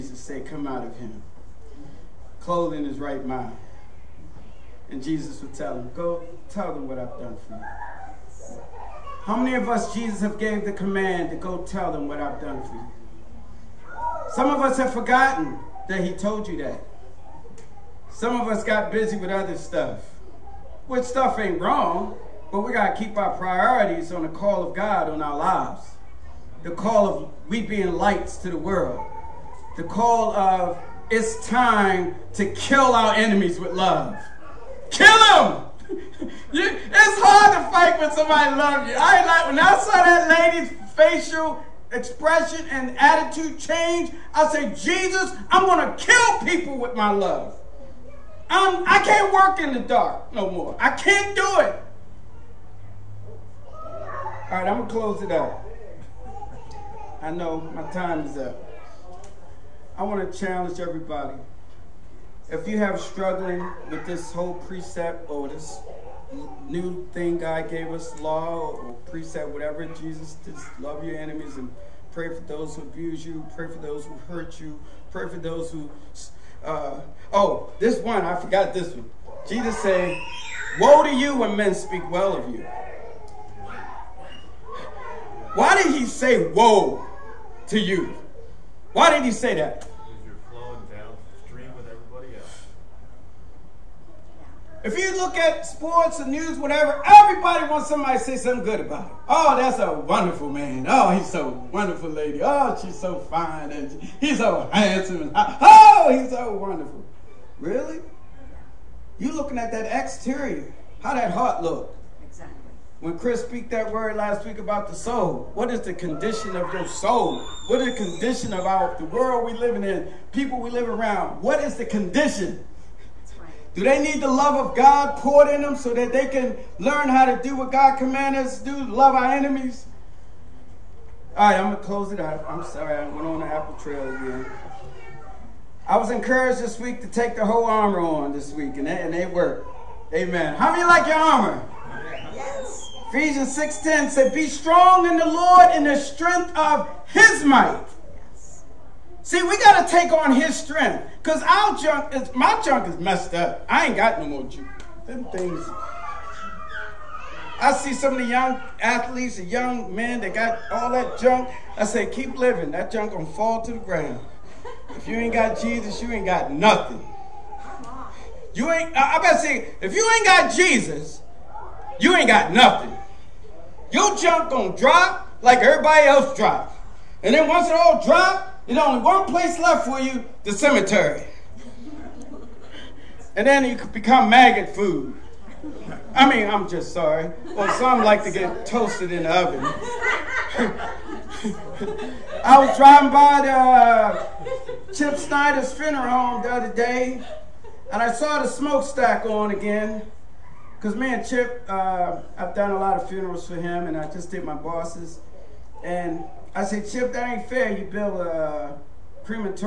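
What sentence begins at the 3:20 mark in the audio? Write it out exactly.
Because man, Chip, uh, I've done a lot of funerals for him, and I just did my boss's.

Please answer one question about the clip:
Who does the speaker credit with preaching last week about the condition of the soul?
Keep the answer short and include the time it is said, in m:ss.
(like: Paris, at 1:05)
Chris, at 1:53.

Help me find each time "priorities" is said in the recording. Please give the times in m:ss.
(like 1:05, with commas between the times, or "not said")
0:23.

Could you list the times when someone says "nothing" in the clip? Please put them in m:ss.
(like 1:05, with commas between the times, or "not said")
2:46, 2:52.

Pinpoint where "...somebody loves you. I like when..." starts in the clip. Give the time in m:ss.
0:38.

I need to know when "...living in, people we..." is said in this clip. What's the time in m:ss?
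1:59.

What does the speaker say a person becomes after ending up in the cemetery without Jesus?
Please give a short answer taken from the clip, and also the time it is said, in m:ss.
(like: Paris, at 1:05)
maggot food, at 3:04.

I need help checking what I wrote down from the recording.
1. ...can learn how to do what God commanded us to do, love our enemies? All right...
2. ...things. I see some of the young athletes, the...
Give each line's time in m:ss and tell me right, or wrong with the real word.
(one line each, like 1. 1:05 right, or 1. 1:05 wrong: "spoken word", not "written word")
1. 2:06 right
2. 2:35 right.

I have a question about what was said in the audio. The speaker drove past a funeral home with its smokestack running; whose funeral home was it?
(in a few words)
Chip Snyder's.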